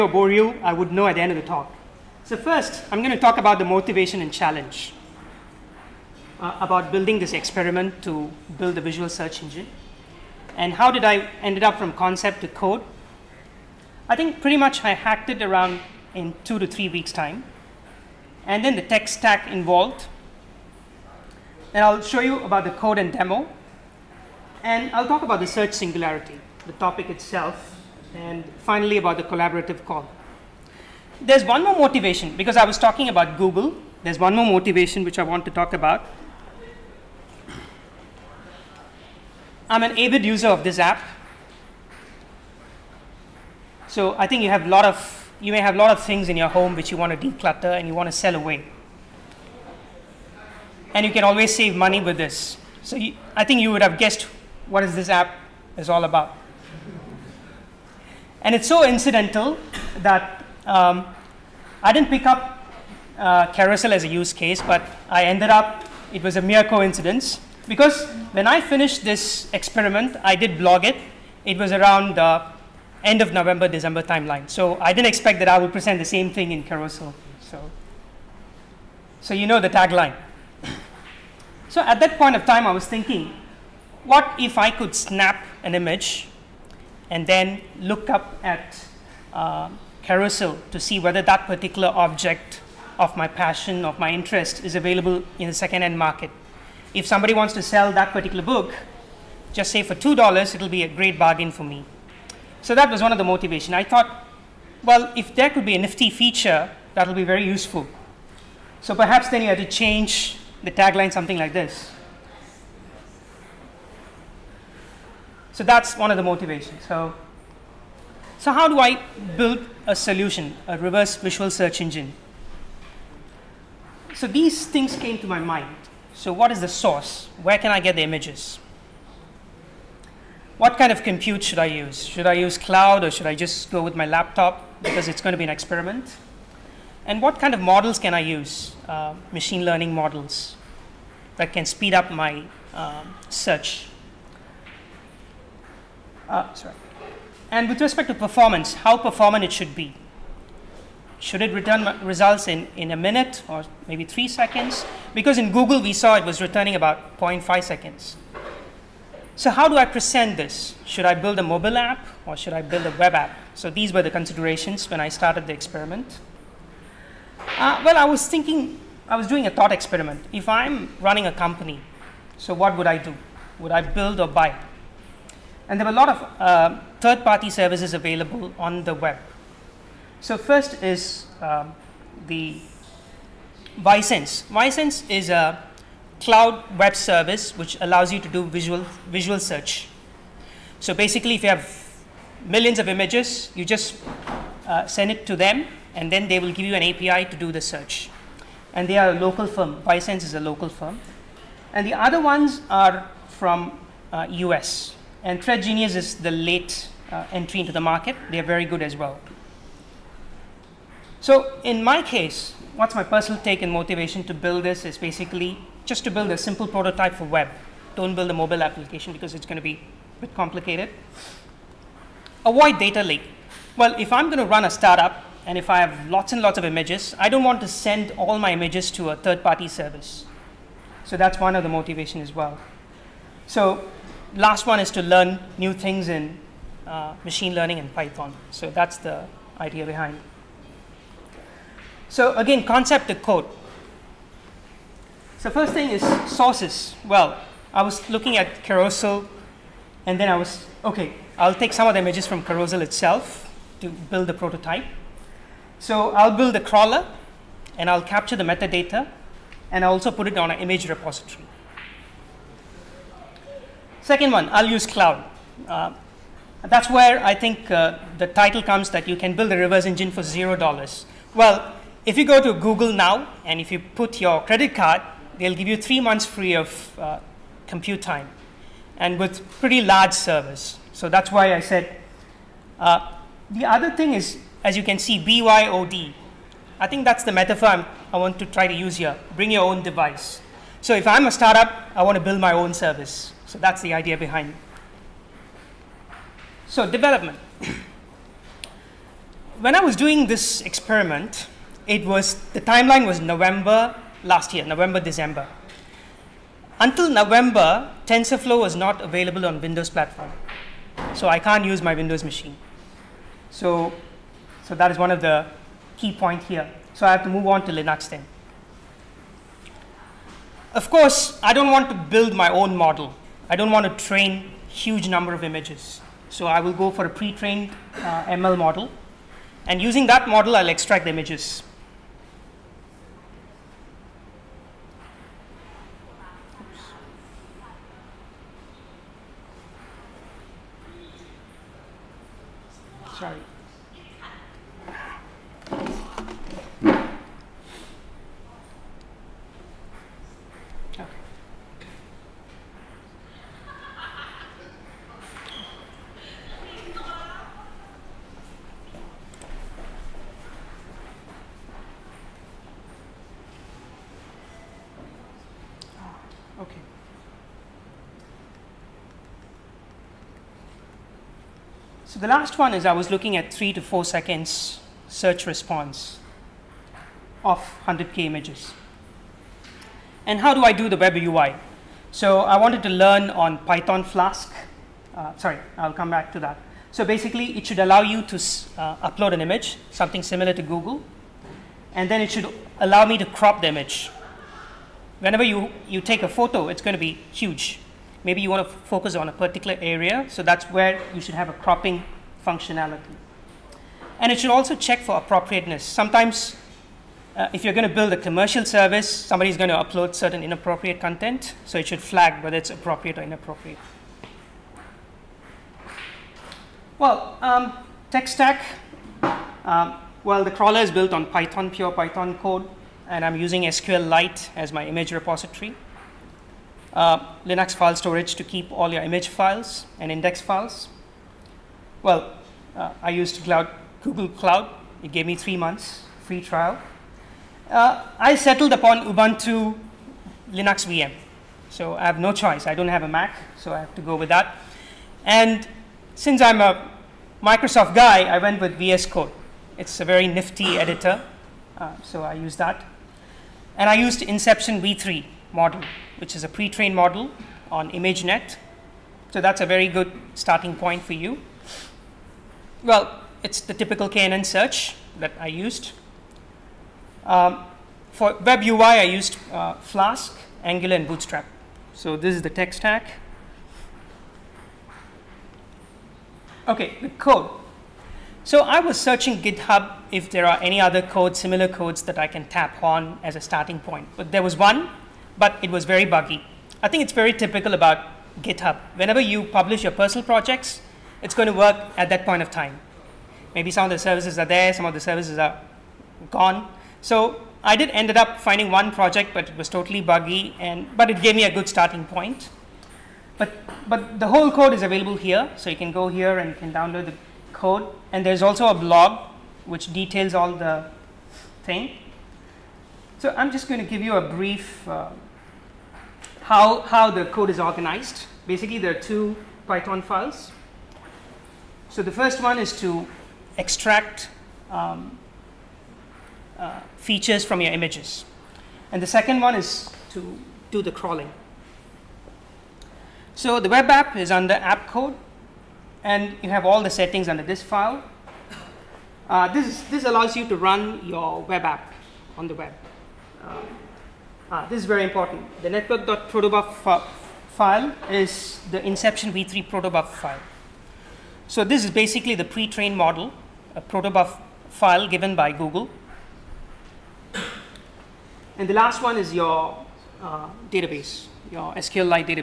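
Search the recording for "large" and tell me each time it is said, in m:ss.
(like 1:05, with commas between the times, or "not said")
4:39.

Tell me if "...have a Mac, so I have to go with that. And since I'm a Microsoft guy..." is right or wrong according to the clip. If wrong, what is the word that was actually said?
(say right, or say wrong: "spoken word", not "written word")
right.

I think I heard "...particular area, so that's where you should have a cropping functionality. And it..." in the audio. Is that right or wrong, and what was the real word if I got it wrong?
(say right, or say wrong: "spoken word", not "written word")
right.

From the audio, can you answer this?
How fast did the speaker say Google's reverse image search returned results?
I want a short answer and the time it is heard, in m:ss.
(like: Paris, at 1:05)
0.5 seconds, at 2:37.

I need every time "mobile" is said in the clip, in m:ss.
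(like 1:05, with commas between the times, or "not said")
2:41, 3:38.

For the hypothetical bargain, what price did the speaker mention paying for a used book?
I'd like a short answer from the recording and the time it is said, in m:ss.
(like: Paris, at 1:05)
$2, at 1:39.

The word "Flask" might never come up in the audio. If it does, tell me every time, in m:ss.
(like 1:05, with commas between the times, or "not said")
6:24, 7:49.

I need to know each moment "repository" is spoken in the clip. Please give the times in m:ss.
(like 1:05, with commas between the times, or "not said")
4:20, 7:05.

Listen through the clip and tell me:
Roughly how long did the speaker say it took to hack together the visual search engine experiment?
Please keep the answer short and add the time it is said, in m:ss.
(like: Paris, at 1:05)
2 to 3 weeks, at 0:16.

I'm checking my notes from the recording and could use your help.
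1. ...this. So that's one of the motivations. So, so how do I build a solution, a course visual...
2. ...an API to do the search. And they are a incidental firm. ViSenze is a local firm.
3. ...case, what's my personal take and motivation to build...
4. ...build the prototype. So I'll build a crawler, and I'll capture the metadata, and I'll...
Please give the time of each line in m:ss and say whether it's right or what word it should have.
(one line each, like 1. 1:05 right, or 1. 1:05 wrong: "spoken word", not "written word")
1. 1:51 wrong: "reverse", not "course"
2. 3:16 wrong: "local", not "incidental"
3. 3:32 right
4. 4:13 right.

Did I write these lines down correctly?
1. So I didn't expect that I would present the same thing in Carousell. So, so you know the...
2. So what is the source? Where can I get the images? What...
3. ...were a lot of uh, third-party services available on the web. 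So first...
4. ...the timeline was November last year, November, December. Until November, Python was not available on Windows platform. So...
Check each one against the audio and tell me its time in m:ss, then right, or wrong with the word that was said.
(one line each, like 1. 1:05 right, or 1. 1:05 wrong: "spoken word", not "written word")
1. 1:14 right
2. 2:06 right
3. 2:55 right
4. 5:02 wrong: "TensorFlow", not "Python".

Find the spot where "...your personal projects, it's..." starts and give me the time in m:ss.
8:09.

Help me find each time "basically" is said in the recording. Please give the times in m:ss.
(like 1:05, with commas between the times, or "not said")
3:10, 3:34, 6:27, 8:38, 9:11.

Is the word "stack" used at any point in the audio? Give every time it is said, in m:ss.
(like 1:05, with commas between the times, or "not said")
0:19, 6:58, 7:52.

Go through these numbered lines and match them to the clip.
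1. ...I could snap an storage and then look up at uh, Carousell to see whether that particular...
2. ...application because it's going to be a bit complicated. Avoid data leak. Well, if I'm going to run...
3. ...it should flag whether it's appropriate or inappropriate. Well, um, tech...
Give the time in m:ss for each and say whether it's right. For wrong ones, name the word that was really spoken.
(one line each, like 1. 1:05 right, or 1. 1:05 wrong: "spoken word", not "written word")
1. 1:24 wrong: "image", not "storage"
2. 3:38 right
3. 6:51 right.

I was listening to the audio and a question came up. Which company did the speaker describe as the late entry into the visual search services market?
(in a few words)
Thread Genius.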